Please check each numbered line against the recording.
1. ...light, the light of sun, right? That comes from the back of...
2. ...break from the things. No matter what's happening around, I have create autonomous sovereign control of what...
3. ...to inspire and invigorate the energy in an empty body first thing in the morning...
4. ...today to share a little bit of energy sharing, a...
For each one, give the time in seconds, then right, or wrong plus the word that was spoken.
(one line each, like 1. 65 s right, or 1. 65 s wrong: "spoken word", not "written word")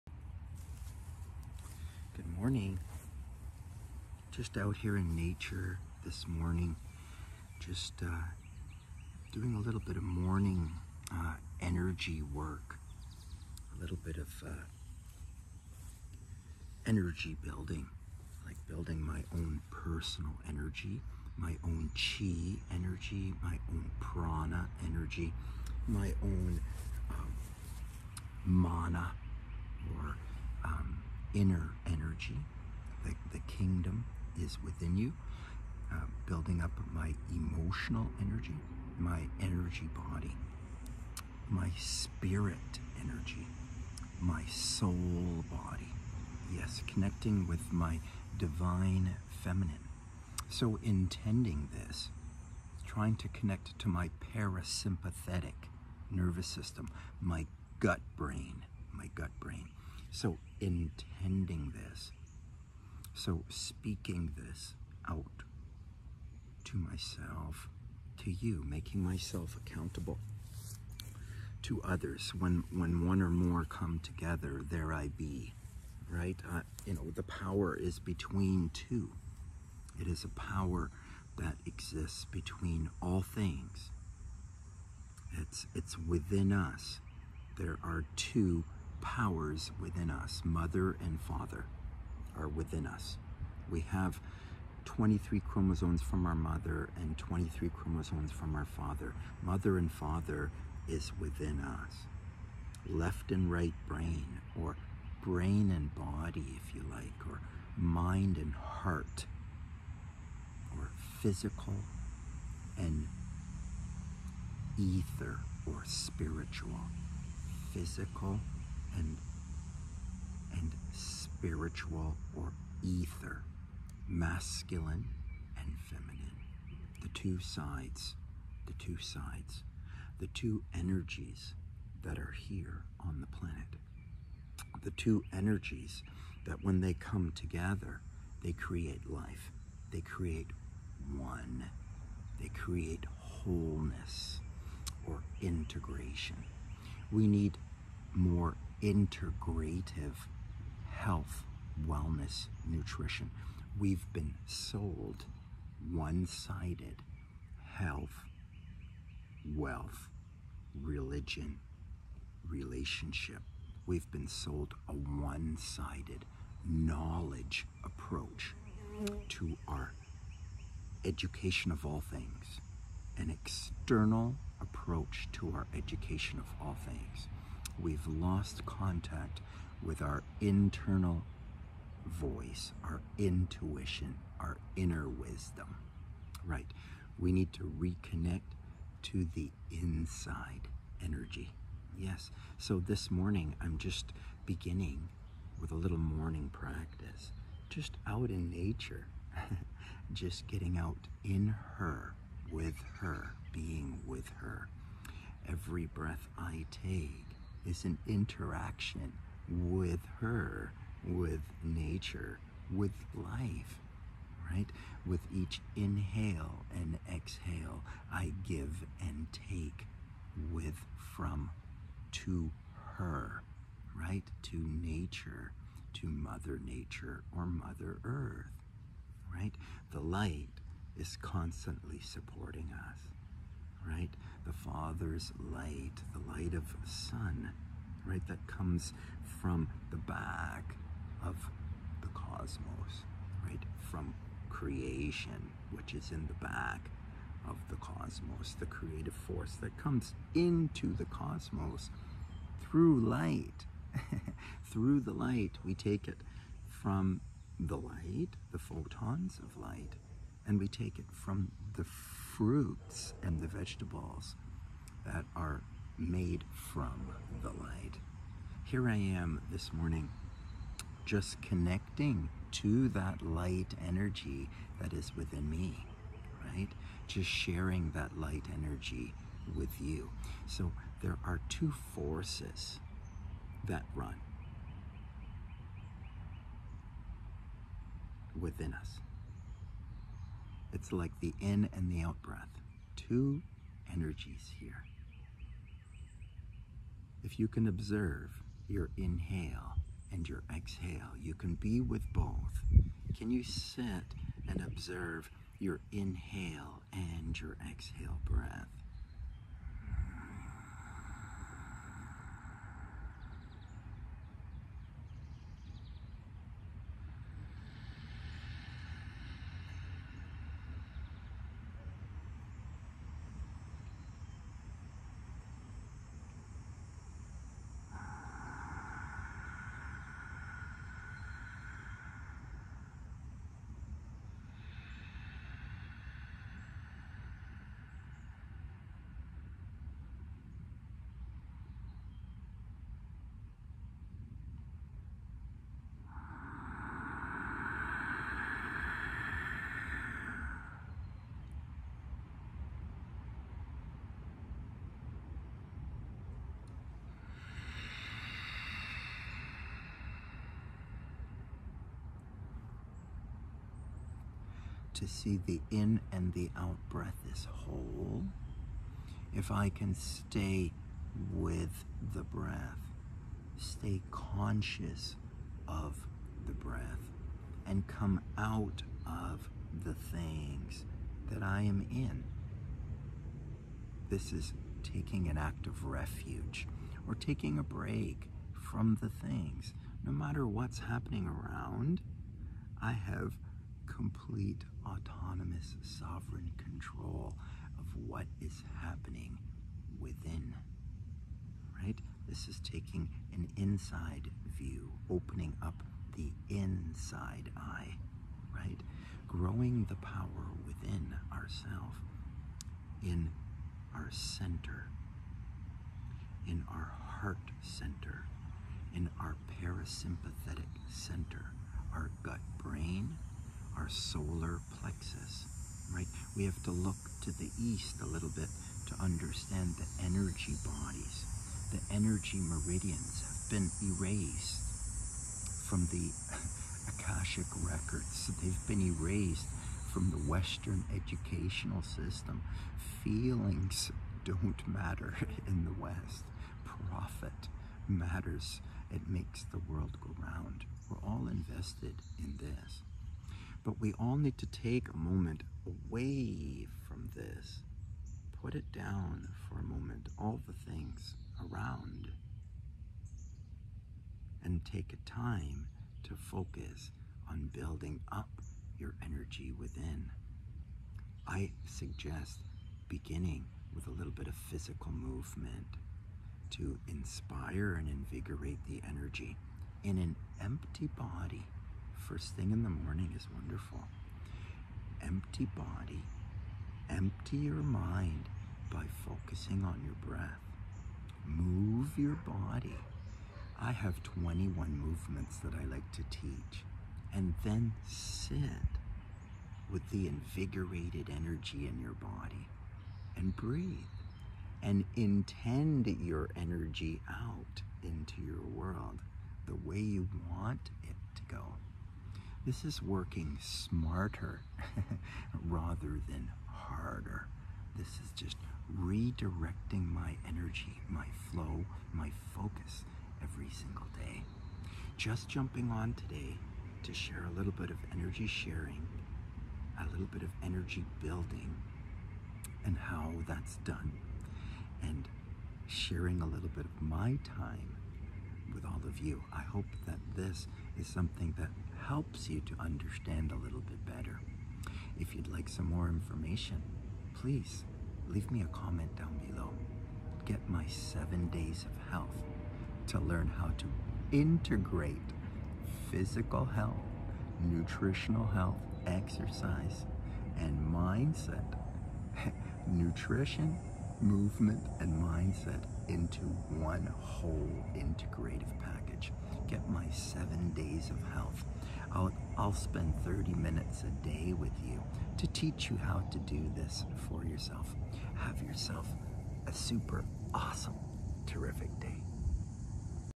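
1. 235 s right
2. 387 s wrong: "complete", not "create"
3. 476 s right
4. 525 s right.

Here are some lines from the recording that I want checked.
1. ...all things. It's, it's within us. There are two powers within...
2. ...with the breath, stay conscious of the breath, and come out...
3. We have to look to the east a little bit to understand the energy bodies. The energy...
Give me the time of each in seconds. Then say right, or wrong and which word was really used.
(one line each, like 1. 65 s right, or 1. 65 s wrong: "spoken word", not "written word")
1. 83 s right
2. 371 s right
3. 426 s right.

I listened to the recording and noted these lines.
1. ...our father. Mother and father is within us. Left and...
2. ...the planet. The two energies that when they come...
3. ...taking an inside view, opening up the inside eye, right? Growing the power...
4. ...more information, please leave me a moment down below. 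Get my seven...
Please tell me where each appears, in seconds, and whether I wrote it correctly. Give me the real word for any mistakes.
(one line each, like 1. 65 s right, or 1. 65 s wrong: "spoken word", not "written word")
1. 98 s right
2. 133 s right
3. 402 s right
4. 545 s wrong: "comment", not "moment".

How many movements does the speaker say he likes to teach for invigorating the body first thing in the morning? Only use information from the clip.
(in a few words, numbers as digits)
21.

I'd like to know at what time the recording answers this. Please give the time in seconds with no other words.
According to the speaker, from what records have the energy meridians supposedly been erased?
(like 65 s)
436 s.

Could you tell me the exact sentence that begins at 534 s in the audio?
And sharing a little bit of my time with all of you.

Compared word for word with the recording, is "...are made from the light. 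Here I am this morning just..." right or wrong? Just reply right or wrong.
right.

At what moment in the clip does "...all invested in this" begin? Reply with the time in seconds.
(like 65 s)
451 s.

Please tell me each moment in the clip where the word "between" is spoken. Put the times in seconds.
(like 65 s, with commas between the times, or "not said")
77 s, 82 s.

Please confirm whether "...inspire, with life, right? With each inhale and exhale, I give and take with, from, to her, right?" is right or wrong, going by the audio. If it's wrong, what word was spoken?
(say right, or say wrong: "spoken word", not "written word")
wrong: "nature", not "inspire".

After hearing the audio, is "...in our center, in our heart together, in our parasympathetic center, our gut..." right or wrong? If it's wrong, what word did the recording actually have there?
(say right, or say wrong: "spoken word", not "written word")
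wrong: "center", not "together".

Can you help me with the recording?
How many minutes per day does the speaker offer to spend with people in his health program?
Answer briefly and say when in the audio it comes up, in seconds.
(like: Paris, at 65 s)
30, at 573 s.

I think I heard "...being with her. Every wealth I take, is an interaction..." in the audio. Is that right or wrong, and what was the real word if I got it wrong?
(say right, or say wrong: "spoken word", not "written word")
wrong: "breath", not "wealth".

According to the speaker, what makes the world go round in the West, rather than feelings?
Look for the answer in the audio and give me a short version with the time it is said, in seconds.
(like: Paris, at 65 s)
Profit, at 446 s.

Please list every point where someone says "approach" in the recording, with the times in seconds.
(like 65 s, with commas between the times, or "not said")
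167 s, 174 s.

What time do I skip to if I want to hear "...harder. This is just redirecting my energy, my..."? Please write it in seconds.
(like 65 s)
516 s.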